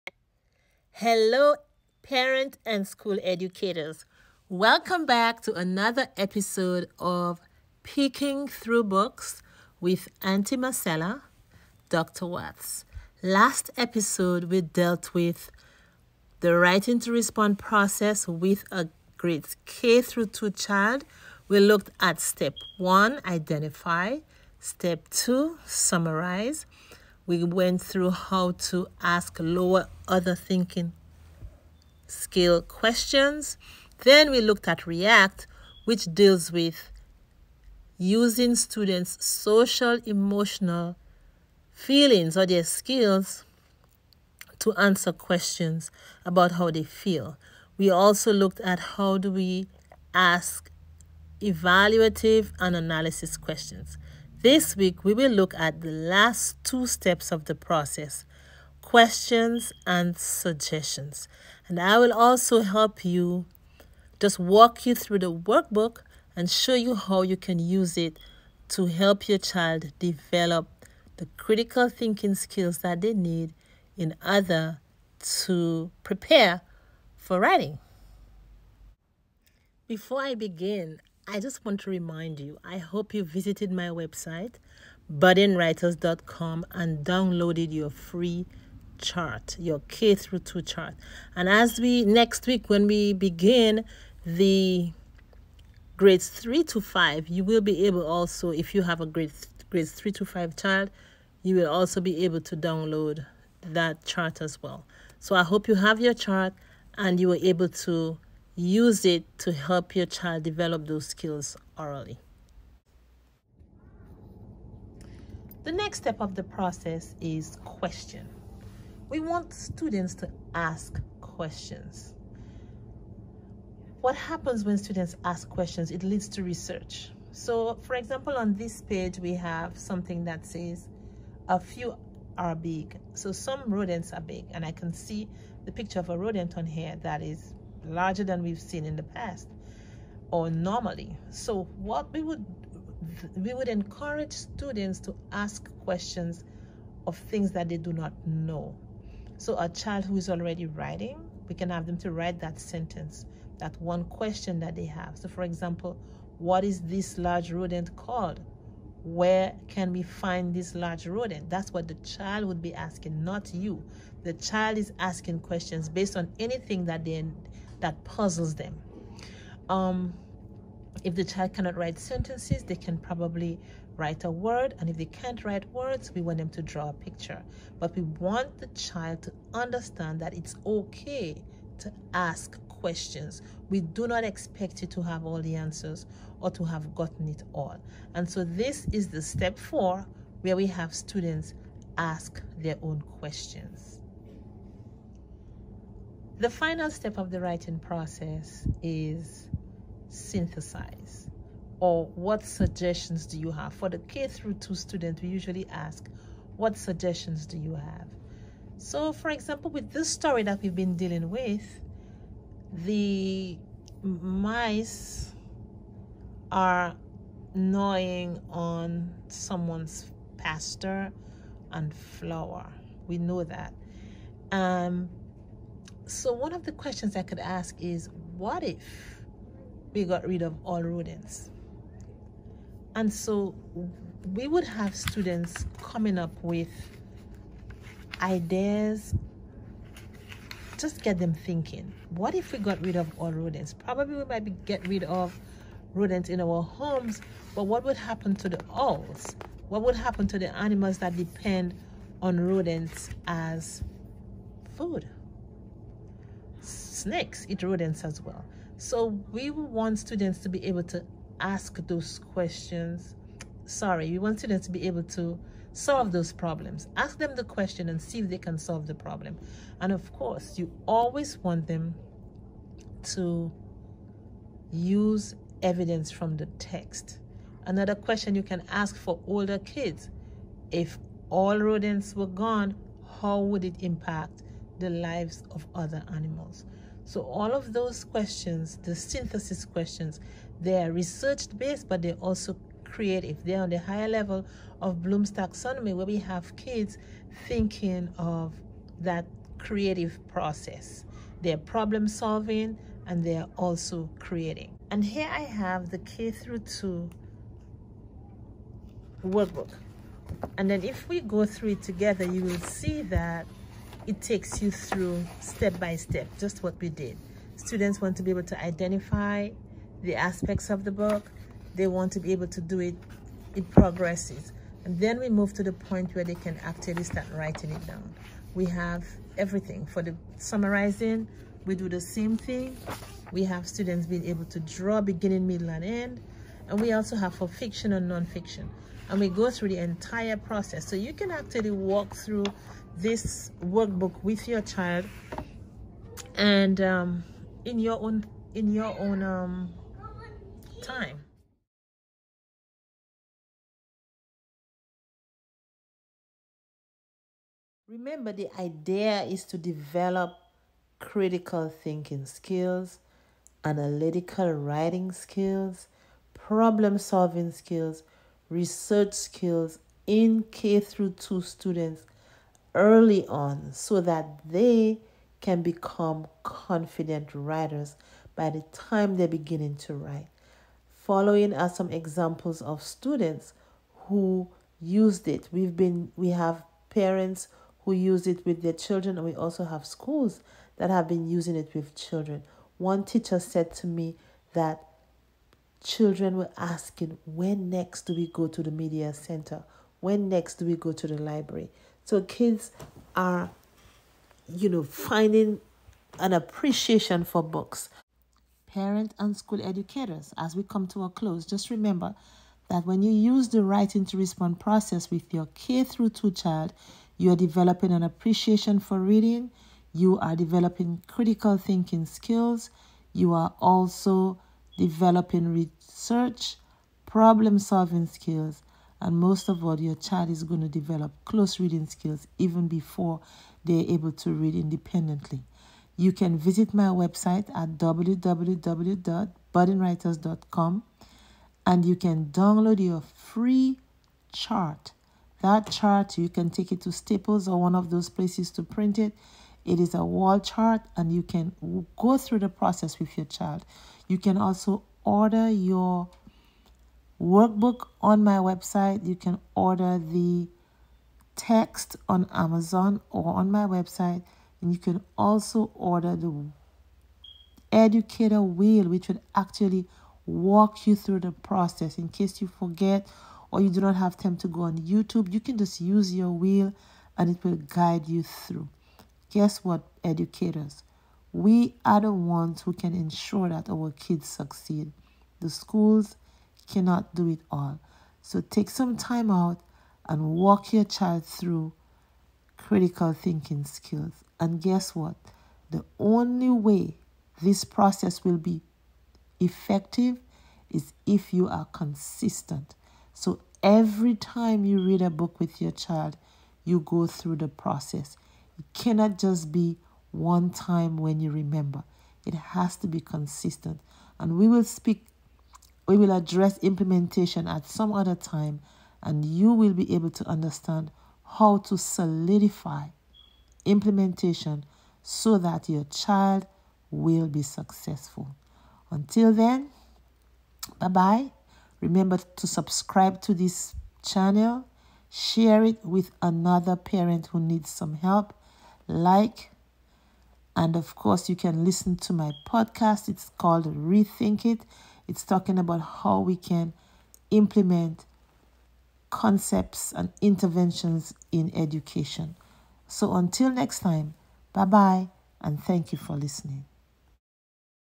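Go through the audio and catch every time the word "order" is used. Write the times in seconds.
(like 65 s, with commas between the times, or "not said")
30 s, 74 s, 455 s, 459 s, 465 s.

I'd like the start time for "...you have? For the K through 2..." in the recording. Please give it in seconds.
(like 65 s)
203 s.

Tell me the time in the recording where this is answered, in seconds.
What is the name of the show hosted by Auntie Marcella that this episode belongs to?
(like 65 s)
7 s.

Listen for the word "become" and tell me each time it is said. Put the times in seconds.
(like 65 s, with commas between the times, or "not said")
375 s.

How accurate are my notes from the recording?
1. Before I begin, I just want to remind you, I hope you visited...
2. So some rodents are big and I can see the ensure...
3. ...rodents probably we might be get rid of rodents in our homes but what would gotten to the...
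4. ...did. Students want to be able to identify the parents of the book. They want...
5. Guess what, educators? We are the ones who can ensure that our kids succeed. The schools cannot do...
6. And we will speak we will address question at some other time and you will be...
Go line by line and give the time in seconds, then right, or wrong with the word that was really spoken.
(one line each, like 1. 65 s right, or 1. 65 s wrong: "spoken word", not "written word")
1. 79 s right
2. 133 s wrong: "picture", not "ensure"
3. 243 s wrong: "happen", not "gotten"
4. 316 s wrong: "aspects", not "parents"
5. 479 s right
6. 514 s wrong: "implementation", not "question".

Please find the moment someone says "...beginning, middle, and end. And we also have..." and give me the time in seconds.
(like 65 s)
335 s.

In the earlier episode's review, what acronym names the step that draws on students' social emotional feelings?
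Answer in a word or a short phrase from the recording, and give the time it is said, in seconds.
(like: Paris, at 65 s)
REACT, at 34 s.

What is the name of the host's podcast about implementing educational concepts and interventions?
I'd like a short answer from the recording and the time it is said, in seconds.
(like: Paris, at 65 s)
Rethink It, at 543 s.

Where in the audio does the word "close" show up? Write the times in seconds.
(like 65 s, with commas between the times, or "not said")
411 s, 431 s.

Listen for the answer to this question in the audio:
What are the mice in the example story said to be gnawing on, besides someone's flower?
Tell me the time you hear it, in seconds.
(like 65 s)
220 s.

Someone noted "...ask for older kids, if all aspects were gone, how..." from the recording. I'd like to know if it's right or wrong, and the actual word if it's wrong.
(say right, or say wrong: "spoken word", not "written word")
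wrong: "rodents", not "aspects".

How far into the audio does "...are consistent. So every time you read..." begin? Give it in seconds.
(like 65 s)
501 s.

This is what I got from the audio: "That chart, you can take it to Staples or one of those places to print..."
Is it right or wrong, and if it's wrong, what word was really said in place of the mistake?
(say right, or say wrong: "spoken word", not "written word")
right.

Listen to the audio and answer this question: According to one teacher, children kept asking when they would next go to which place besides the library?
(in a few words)
Media center.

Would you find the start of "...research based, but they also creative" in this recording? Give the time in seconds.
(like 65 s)
290 s.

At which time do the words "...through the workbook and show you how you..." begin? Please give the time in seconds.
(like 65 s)
64 s.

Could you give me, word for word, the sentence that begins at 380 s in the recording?
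Following are some examples of students who used it.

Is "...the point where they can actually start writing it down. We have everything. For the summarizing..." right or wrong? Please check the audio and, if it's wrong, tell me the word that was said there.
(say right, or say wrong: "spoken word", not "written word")
right.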